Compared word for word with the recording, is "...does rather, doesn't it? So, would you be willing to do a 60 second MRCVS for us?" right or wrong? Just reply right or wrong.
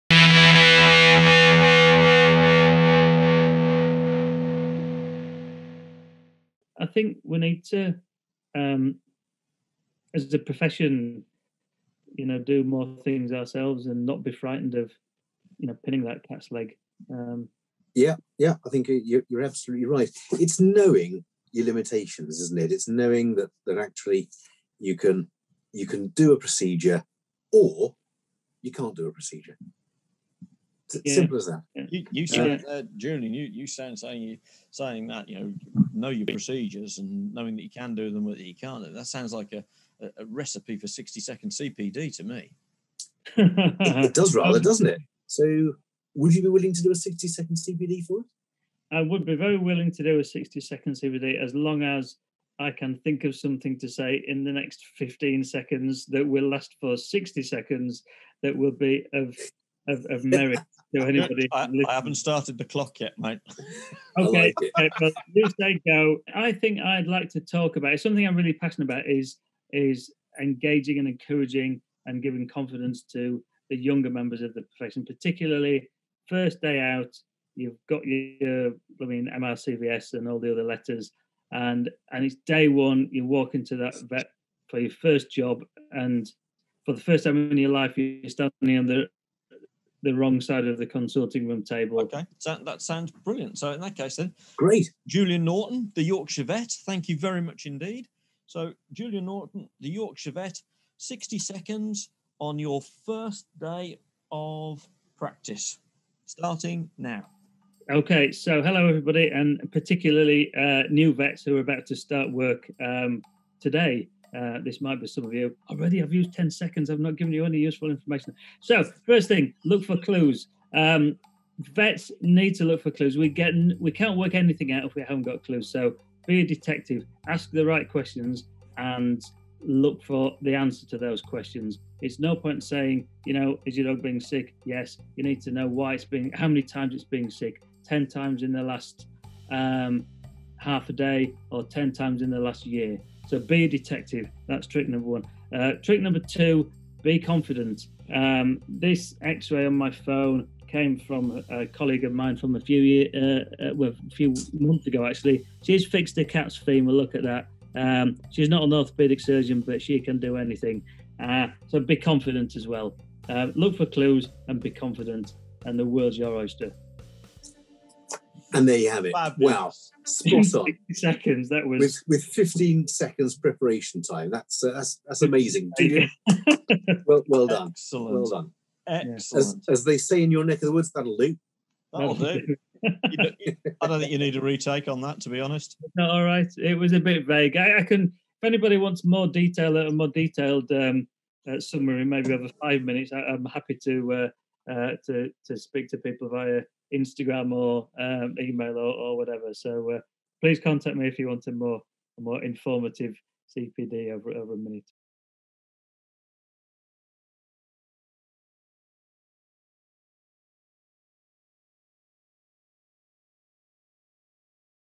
wrong.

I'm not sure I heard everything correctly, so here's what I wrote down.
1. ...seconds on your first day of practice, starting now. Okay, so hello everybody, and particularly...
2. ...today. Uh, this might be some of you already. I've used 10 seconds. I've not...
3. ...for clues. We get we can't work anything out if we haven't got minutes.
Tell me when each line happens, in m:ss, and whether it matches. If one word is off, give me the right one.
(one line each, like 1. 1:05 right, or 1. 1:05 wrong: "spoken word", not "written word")
1. 1:41 right
2. 1:53 right
3. 2:02 wrong: "clues", not "minutes".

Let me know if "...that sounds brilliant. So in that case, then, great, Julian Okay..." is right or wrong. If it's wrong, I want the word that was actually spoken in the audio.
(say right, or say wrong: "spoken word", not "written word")
wrong: "Norton", not "Okay".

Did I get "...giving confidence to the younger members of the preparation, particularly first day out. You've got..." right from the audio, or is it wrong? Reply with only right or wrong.
wrong.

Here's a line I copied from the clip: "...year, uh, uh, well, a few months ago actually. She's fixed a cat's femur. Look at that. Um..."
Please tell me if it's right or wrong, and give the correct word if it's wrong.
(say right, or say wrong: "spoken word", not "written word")
right.